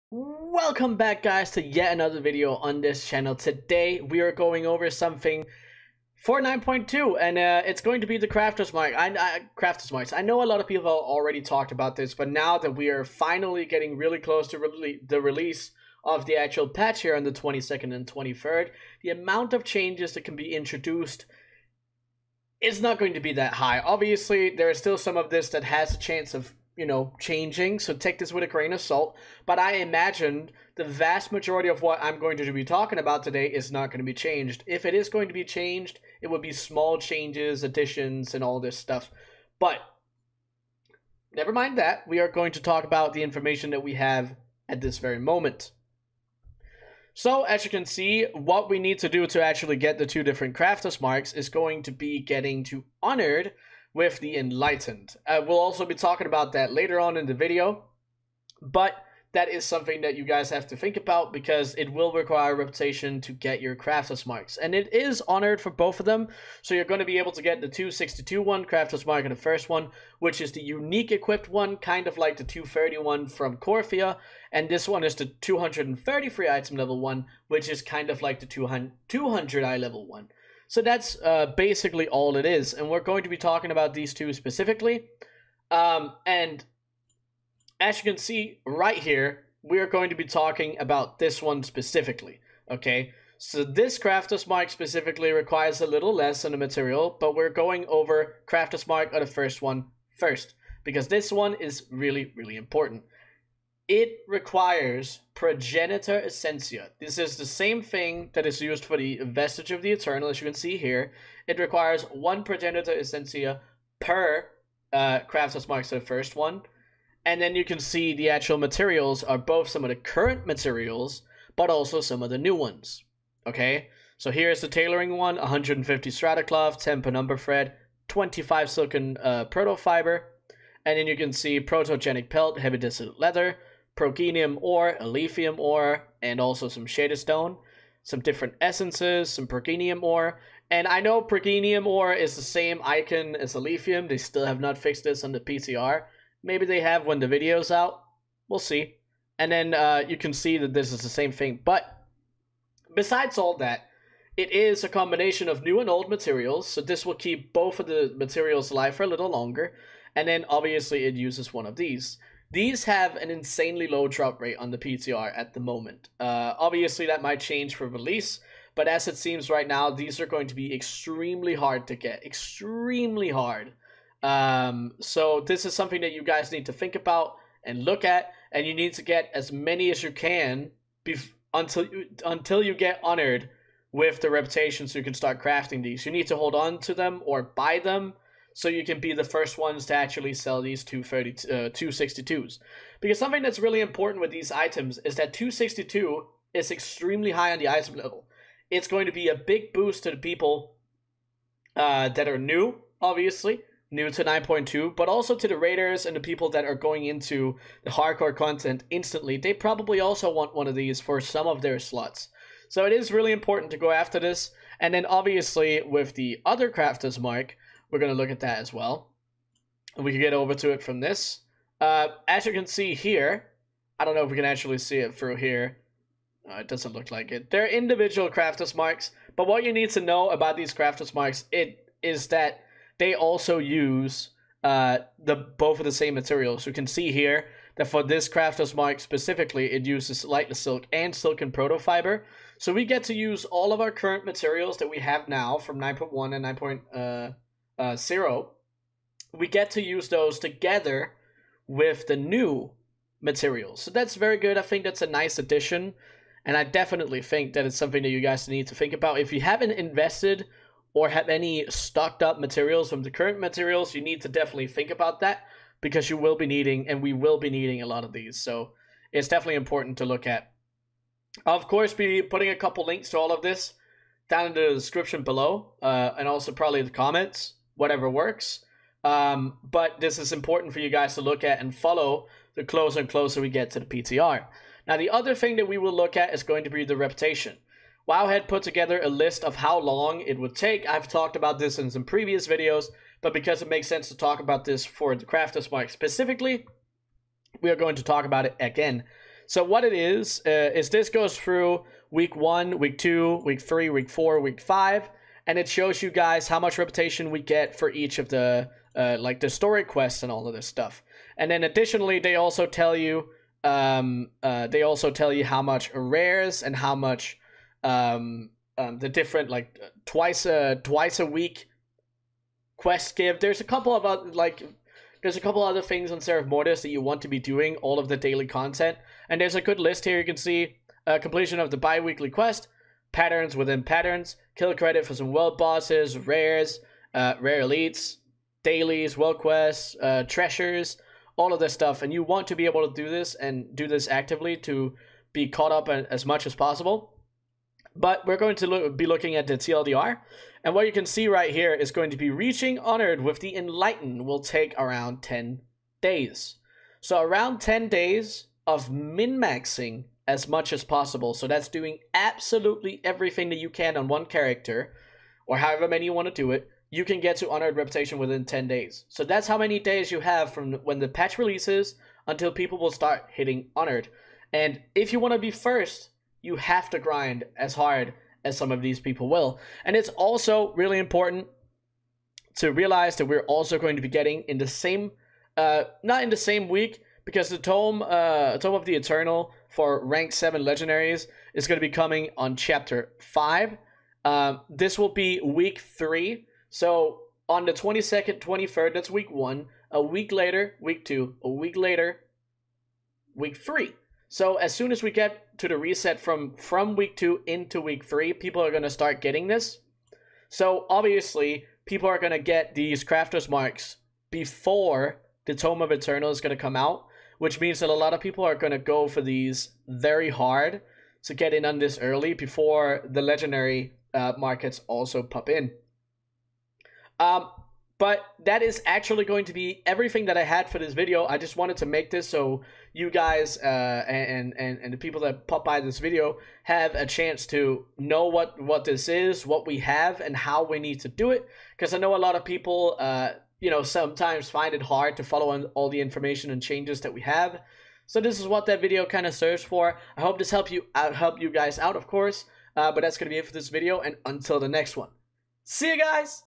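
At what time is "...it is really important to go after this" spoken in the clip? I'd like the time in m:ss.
3:32.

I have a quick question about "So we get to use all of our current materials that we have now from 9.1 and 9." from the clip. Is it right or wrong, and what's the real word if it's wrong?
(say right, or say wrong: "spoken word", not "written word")
right.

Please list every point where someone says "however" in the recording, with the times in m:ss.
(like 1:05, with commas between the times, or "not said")
6:05.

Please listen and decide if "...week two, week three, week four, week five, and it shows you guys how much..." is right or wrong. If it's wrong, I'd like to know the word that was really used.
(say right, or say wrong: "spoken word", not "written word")
right.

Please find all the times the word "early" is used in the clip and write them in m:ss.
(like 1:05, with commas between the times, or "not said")
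7:01.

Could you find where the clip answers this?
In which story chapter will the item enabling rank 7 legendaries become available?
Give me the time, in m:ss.
6:32.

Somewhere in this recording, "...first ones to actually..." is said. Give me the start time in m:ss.
3:09.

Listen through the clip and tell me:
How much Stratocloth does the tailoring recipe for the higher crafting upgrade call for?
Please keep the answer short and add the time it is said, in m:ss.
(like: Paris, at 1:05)
150, at 2:05.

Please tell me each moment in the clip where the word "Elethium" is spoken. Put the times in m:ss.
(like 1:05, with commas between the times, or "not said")
2:14, 2:23.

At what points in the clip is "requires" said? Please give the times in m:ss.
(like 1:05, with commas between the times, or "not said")
1:02, 1:35, 1:44, 1:51.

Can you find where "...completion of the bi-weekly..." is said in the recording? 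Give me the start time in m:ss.
5:31.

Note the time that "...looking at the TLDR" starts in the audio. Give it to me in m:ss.
5:49.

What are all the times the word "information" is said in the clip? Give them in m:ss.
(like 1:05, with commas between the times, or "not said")
0:43, 7:26.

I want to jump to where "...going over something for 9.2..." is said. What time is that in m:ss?
0:04.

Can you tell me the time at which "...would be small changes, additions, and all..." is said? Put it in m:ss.
0:36.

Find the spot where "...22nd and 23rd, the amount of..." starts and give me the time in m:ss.
0:17.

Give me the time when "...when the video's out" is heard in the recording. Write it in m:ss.
2:27.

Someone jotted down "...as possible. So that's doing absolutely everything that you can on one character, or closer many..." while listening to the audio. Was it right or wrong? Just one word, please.
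wrong.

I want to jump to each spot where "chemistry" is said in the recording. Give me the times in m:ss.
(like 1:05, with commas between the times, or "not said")
not said.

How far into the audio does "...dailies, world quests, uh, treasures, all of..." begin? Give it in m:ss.
5:38.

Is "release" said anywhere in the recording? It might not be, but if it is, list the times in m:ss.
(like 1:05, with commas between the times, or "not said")
0:15, 2:47, 6:11.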